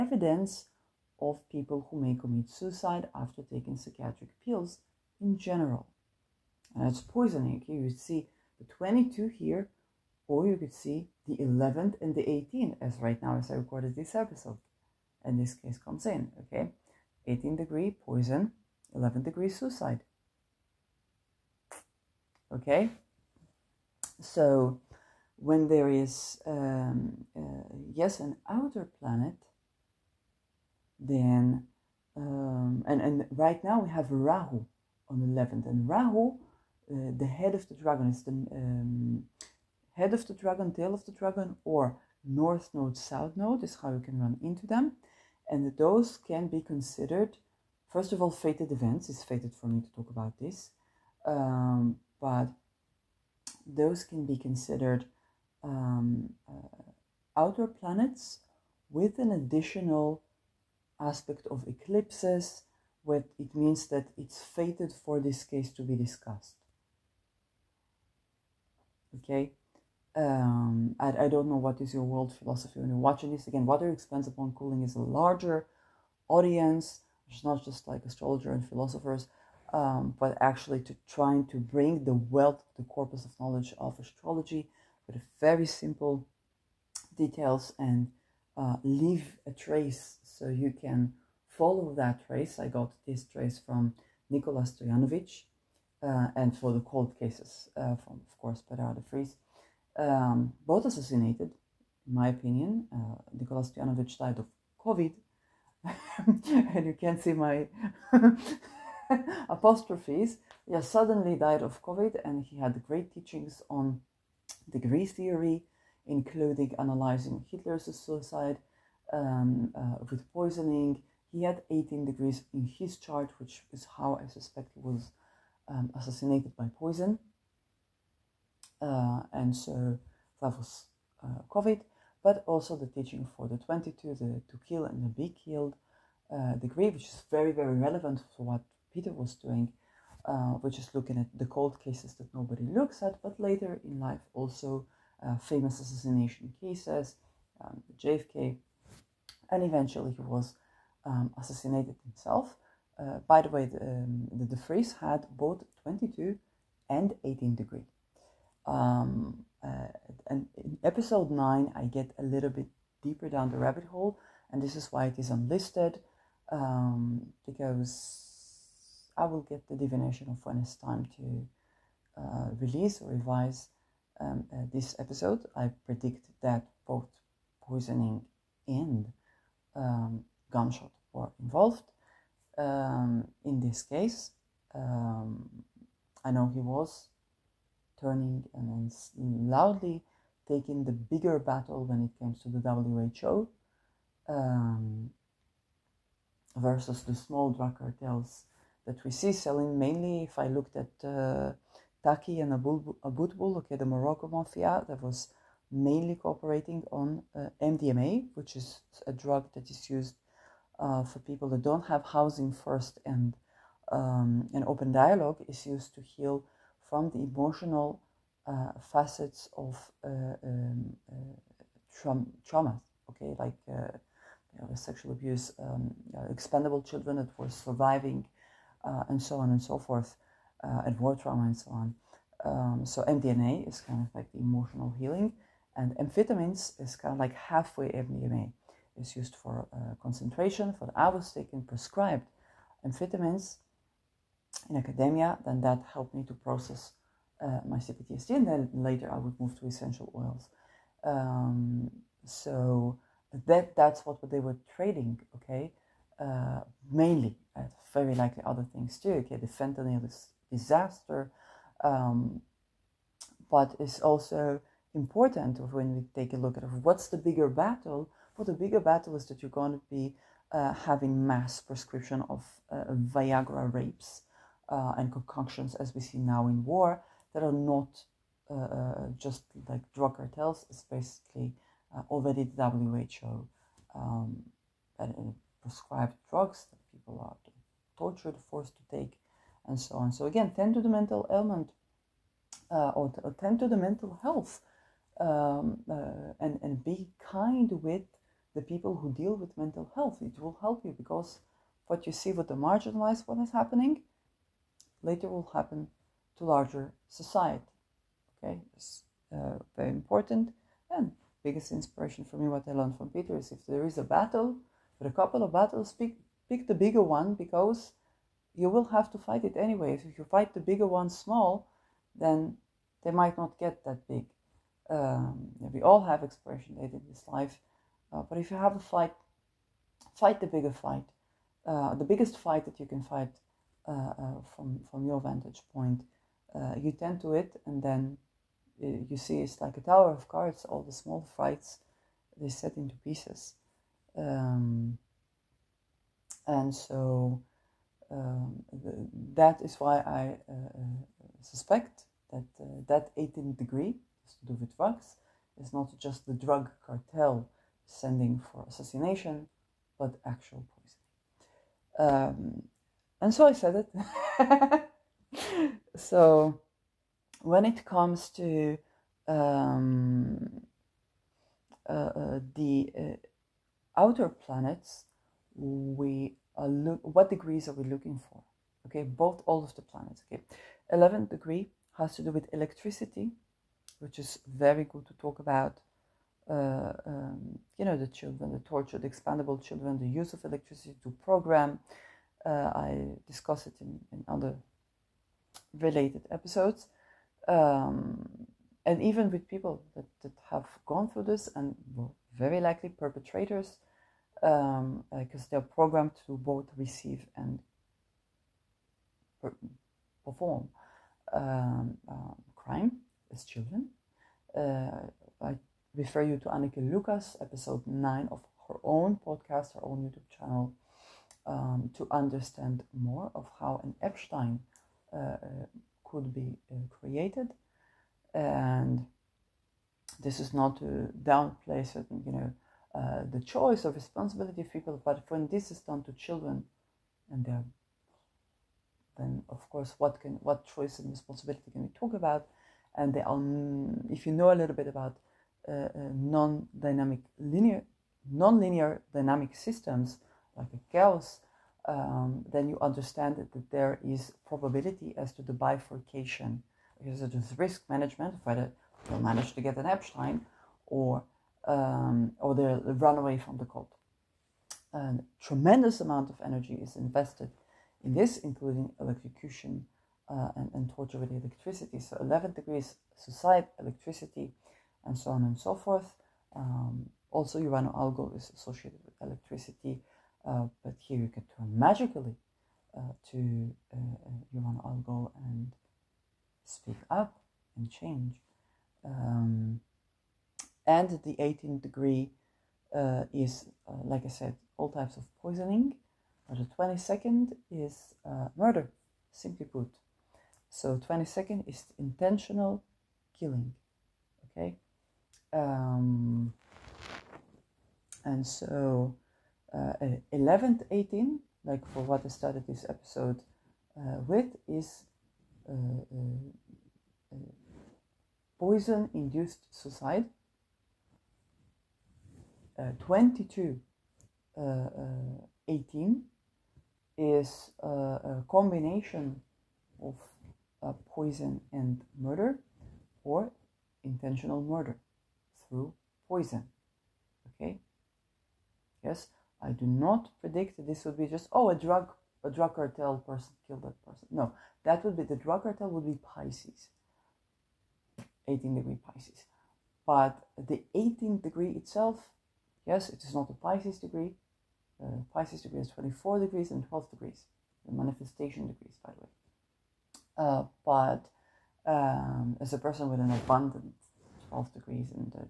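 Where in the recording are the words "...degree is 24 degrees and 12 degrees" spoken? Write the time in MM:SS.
09:15.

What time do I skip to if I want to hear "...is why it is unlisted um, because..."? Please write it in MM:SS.
02:44.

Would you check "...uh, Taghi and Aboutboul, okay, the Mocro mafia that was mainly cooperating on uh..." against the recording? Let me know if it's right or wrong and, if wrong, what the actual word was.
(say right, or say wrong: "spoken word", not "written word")
right.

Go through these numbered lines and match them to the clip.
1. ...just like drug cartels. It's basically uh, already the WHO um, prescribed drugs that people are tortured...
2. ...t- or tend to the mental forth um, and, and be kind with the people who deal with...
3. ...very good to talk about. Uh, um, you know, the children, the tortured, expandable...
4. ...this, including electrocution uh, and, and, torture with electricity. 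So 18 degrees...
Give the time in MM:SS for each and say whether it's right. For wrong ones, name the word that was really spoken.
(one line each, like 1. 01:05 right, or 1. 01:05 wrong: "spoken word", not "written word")
1. 04:39 right
2. 04:53 wrong: "health", not "forth"
3. 06:24 right
4. 07:48 wrong: "11", not "18".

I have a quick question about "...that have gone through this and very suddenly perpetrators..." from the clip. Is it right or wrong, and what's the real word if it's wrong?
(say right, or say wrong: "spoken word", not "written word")
wrong: "likely", not "suddenly".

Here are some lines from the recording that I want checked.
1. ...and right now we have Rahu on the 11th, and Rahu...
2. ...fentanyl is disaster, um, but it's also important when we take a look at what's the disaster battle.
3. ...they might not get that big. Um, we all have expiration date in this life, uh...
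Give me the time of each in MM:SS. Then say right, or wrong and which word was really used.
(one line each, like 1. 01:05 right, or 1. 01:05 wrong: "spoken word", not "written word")
1. 00:32 right
2. 04:19 wrong: "bigger", not "disaster"
3. 05:23 right.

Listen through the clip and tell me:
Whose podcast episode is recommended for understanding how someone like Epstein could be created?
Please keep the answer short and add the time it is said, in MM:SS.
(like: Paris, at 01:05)
Anneke Lucas, at 06:56.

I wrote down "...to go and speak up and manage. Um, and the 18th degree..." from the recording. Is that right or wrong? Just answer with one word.
wrong.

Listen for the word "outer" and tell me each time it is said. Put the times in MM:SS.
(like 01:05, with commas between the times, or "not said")
00:28, 00:57, 06:13.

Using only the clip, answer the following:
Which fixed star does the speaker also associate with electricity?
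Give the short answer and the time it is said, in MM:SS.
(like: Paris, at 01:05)
Algol, at 07:57.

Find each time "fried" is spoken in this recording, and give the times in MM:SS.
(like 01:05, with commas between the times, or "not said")
not said.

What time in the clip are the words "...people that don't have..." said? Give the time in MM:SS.
03:31.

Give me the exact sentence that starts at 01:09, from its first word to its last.
Okay, um, I, I don't know what is your world philosophy when you're watching this.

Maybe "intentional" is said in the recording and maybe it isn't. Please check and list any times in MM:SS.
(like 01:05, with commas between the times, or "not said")
08:21, 08:54.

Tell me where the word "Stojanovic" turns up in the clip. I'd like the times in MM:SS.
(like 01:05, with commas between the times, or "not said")
01:34, 01:43.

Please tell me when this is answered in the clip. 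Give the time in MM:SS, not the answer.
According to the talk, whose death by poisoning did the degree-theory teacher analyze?
01:57.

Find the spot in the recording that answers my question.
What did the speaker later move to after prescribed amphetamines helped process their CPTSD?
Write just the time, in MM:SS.
04:09.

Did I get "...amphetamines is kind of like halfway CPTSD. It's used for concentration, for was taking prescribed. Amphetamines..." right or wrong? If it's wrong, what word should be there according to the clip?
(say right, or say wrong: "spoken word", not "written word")
wrong: "MDMA", not "CPTSD".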